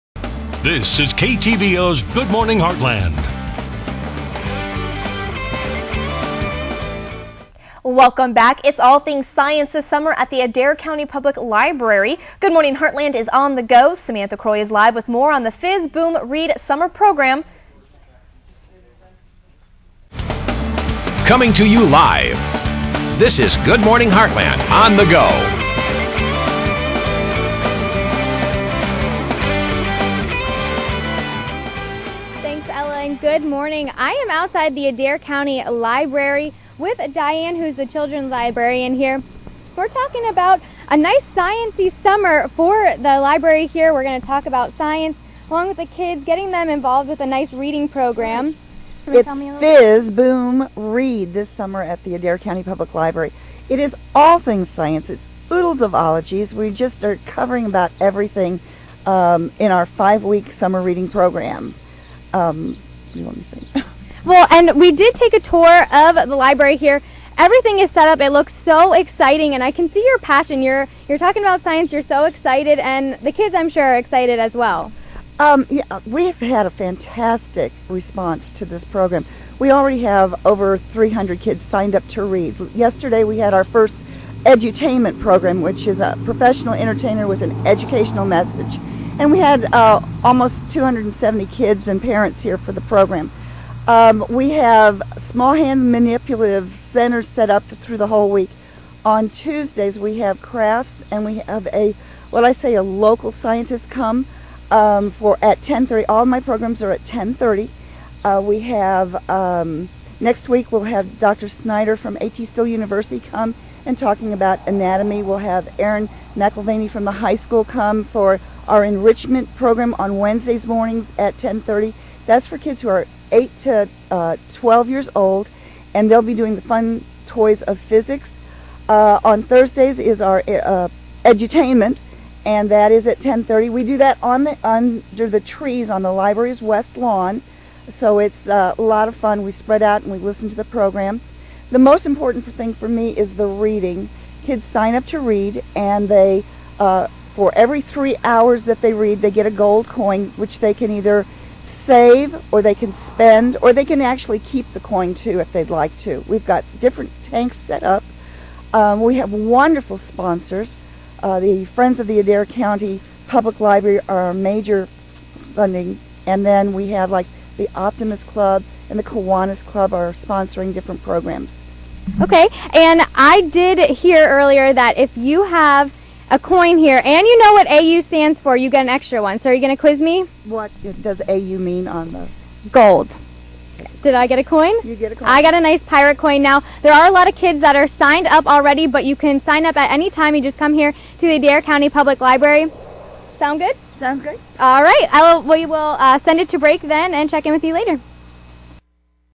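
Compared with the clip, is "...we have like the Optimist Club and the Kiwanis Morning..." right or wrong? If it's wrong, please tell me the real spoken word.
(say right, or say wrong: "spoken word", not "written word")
wrong: "Club", not "Morning".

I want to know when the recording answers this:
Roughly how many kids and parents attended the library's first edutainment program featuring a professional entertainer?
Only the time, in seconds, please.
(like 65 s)
90 s.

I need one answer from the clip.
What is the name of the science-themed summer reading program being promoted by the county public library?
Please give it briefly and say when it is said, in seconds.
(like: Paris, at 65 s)
Fizz Boom Read, at 15 s.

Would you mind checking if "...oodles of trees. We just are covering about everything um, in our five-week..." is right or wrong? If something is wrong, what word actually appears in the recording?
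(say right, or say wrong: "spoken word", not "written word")
wrong: "ologies", not "trees".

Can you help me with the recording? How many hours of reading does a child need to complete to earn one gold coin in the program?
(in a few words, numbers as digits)
3.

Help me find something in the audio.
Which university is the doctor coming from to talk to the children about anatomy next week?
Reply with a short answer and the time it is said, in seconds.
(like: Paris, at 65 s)
AT Still University, at 112 s.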